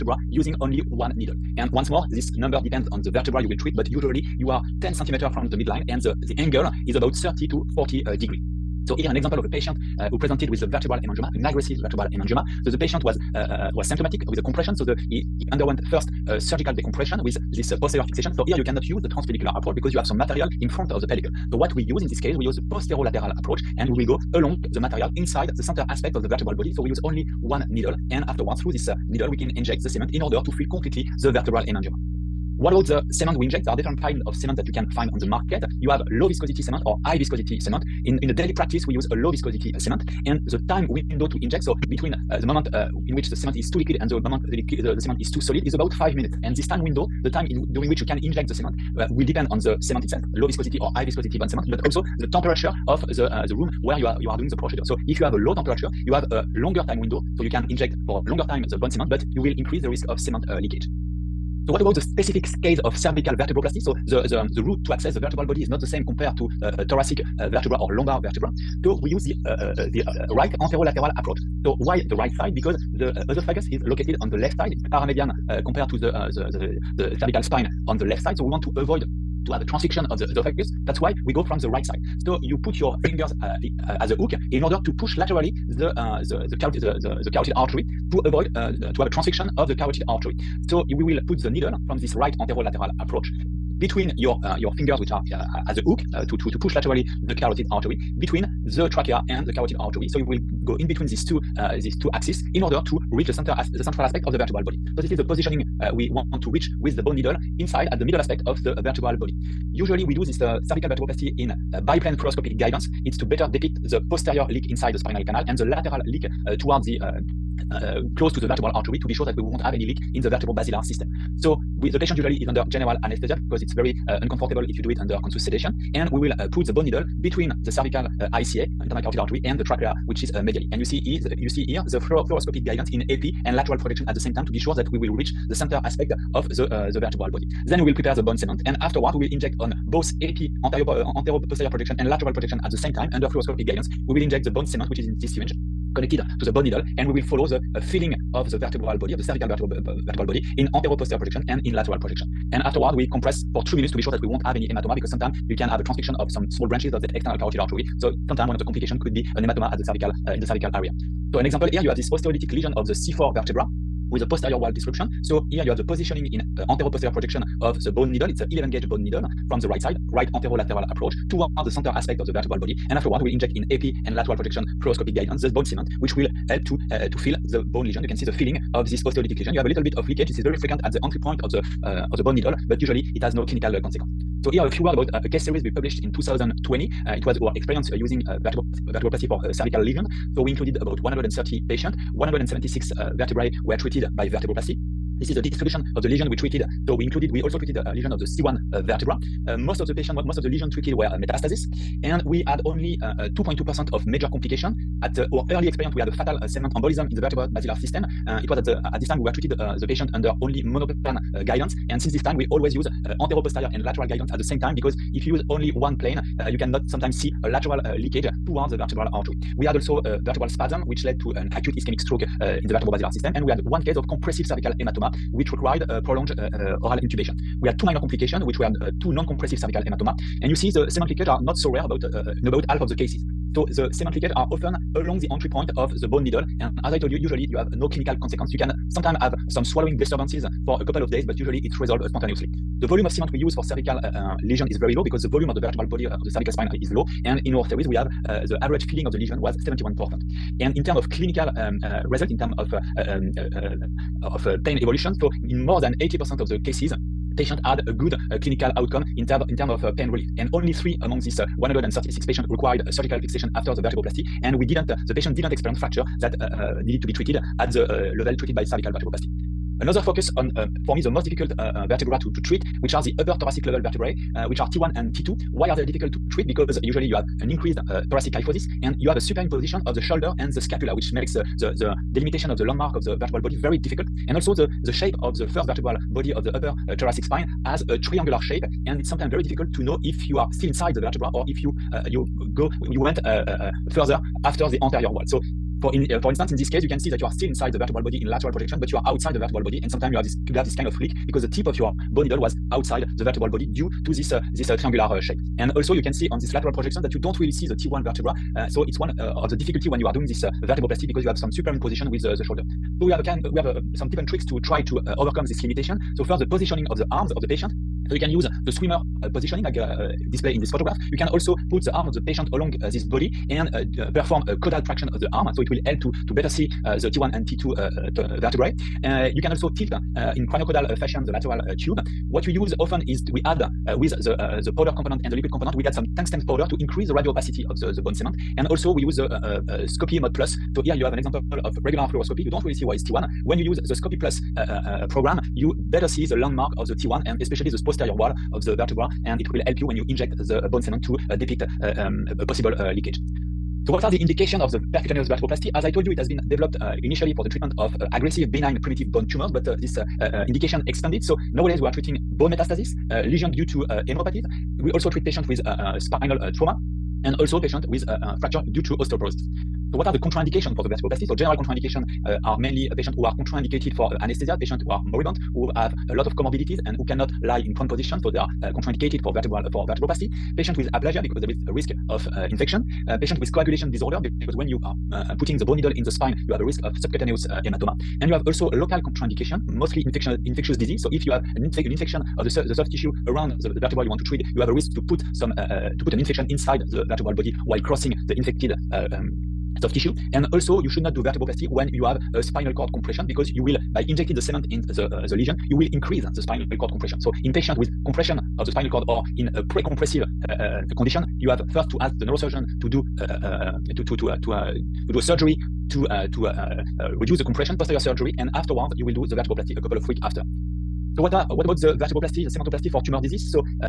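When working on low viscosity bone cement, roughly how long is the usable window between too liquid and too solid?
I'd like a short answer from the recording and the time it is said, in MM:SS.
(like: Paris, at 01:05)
5 minutes, at 00:45.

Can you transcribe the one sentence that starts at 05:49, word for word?
And it will help you when you inject the bone cement to depict um, a possible leakage.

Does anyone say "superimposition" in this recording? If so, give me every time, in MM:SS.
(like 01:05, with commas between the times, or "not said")
04:39, 05:11.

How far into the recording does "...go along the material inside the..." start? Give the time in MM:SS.
00:24.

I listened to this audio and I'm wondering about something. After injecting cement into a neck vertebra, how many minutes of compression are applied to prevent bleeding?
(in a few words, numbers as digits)
2.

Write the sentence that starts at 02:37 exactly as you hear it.
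So sometimes one of the complications could be an hematoma at the cervical uh, in the cervical area.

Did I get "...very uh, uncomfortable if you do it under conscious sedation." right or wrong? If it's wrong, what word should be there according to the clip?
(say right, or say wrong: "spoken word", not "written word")
right.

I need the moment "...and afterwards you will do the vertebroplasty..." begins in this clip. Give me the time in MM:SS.
06:58.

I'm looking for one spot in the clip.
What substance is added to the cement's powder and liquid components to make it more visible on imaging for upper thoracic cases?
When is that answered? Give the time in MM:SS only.
05:36.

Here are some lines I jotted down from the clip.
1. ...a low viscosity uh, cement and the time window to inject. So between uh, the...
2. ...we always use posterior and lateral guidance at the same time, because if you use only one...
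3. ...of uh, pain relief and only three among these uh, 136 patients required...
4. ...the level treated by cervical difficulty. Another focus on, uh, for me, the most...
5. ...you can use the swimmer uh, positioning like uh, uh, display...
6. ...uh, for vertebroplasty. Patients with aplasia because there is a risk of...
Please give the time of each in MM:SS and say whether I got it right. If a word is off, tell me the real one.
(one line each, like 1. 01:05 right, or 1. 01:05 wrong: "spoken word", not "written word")
1. 00:39 right
2. 03:32 wrong: "anteroposterior", not "posterior"
3. 04:19 right
4. 04:27 wrong: "vertebroplasty", not "difficulty"
5. 05:18 right
6. 06:19 right.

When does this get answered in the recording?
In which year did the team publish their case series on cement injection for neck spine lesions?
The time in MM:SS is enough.
03:06.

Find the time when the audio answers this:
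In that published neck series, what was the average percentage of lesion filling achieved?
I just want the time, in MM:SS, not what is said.
04:09.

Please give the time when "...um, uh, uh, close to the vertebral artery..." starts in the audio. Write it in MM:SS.
01:57.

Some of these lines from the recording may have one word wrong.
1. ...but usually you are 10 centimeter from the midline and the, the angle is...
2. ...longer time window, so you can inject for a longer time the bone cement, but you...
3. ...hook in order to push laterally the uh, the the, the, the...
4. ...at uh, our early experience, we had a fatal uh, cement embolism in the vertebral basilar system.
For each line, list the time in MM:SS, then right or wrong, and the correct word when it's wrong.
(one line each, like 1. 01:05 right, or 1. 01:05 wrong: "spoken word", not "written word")
1. 00:03 right
2. 00:56 right
3. 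01:24 right
4. 03:25 right.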